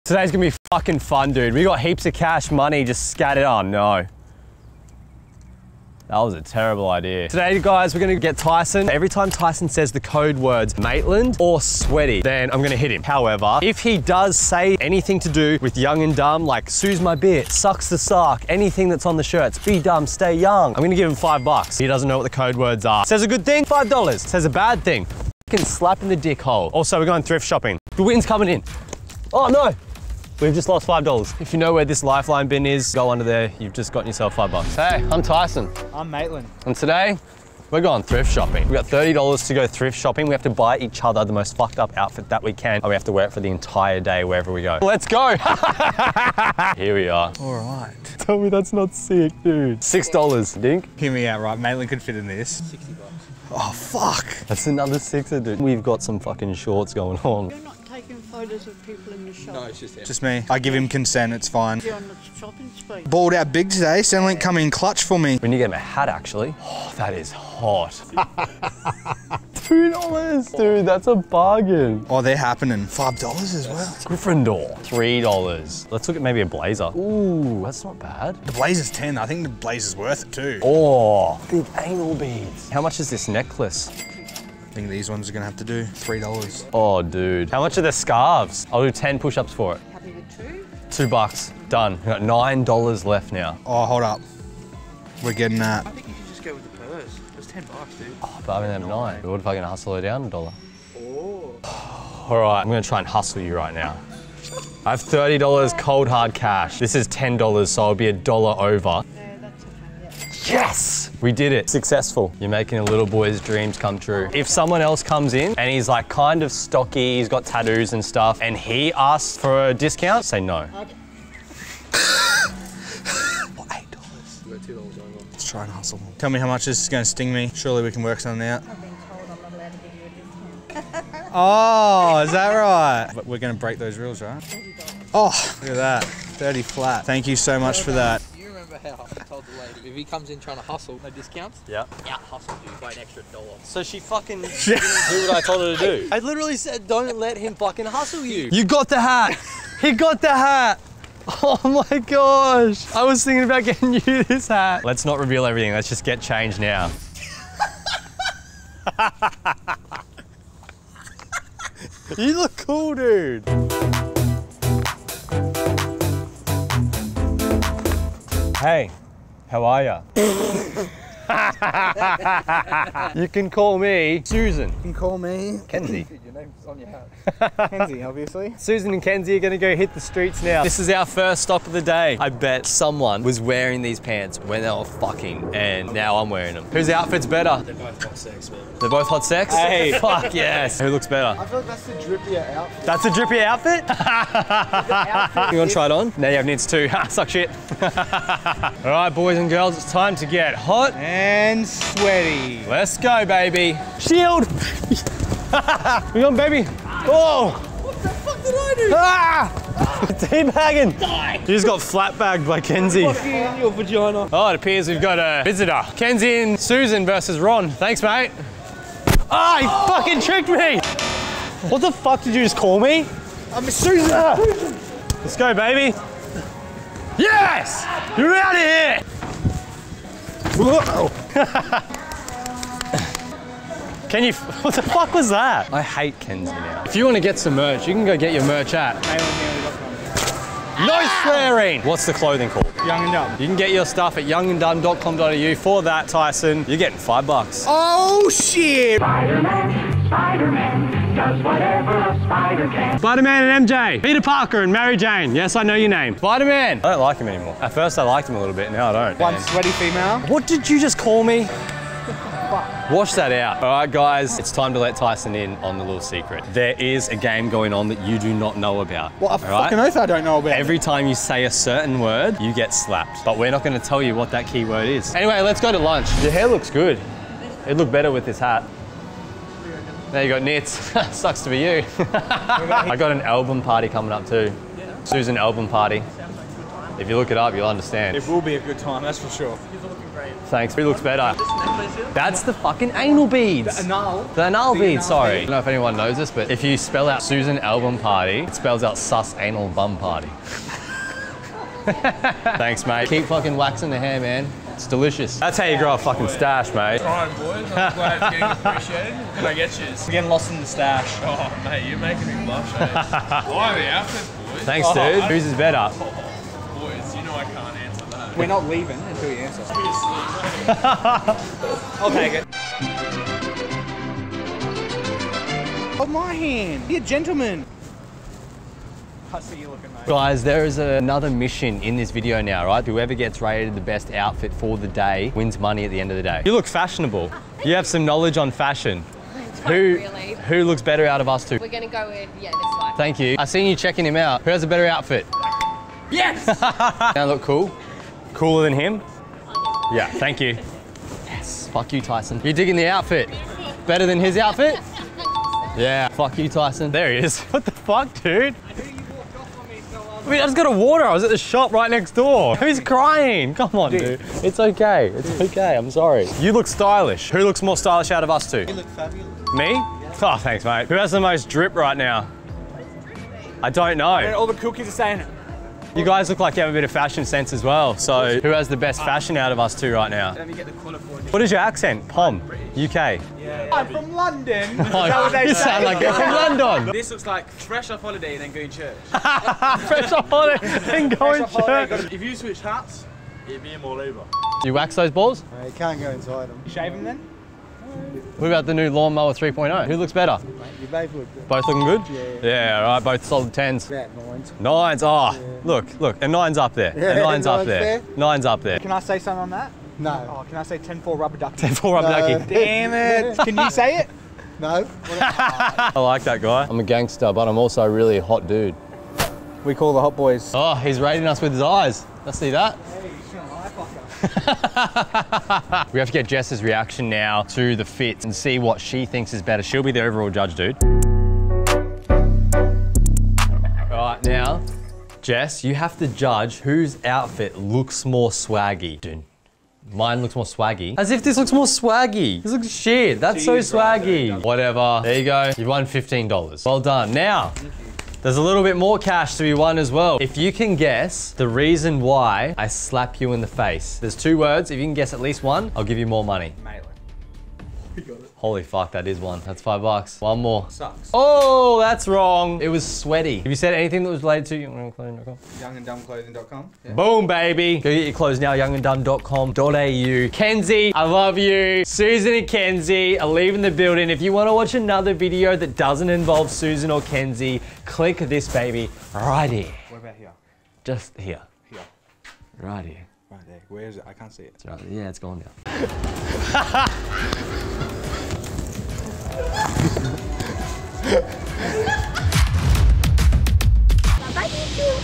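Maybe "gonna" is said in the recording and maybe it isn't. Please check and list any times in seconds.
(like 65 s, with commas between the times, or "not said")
0 s, 8 s, 12 s, 20 s, 85 s, 102 s, 179 s.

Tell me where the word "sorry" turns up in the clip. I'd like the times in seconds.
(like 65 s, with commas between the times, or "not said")
295 s, 365 s.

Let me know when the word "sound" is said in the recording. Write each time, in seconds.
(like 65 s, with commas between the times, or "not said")
385 s.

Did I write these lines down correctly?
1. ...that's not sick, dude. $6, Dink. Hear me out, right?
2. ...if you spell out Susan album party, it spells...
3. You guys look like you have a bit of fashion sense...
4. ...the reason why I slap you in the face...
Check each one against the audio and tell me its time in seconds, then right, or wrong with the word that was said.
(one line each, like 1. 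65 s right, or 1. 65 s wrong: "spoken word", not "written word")
1. 48 s right
2. 296 s right
3. 375 s right
4. 451 s right.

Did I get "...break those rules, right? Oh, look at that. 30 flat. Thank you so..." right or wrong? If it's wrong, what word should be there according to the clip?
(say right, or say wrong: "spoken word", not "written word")
right.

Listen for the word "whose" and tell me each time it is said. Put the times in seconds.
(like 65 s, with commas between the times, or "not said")
186 s, 315 s, 436 s.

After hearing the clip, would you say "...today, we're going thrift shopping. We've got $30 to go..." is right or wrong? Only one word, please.
right.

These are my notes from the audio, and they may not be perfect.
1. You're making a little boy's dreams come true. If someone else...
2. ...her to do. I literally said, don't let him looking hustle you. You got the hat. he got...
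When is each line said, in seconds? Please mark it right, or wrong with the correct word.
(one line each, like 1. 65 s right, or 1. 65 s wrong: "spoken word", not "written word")
1. 112 s right
2. 145 s wrong: "fucking", not "looking".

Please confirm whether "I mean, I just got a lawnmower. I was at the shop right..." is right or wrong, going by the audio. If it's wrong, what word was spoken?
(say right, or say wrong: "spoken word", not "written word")
wrong: "water", not "lawnmower".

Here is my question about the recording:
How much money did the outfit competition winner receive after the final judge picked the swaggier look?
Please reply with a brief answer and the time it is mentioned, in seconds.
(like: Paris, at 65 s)
$15, at 445 s.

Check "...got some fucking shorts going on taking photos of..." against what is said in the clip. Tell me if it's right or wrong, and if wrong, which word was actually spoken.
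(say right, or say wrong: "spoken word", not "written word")
right.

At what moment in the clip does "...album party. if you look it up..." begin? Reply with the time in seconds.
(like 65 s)
285 s.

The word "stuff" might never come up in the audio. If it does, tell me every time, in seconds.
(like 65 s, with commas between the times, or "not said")
118 s, 243 s.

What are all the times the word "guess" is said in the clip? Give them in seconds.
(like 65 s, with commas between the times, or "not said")
450 s, 454 s.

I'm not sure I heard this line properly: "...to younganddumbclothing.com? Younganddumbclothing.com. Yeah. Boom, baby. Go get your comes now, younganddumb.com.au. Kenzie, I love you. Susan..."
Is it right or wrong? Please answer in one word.
wrong.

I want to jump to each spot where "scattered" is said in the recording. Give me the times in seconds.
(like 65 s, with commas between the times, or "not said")
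3 s.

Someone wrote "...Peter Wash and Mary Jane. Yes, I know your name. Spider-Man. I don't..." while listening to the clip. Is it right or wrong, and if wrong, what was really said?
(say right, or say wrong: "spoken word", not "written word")
wrong: "Parker", not "Wash".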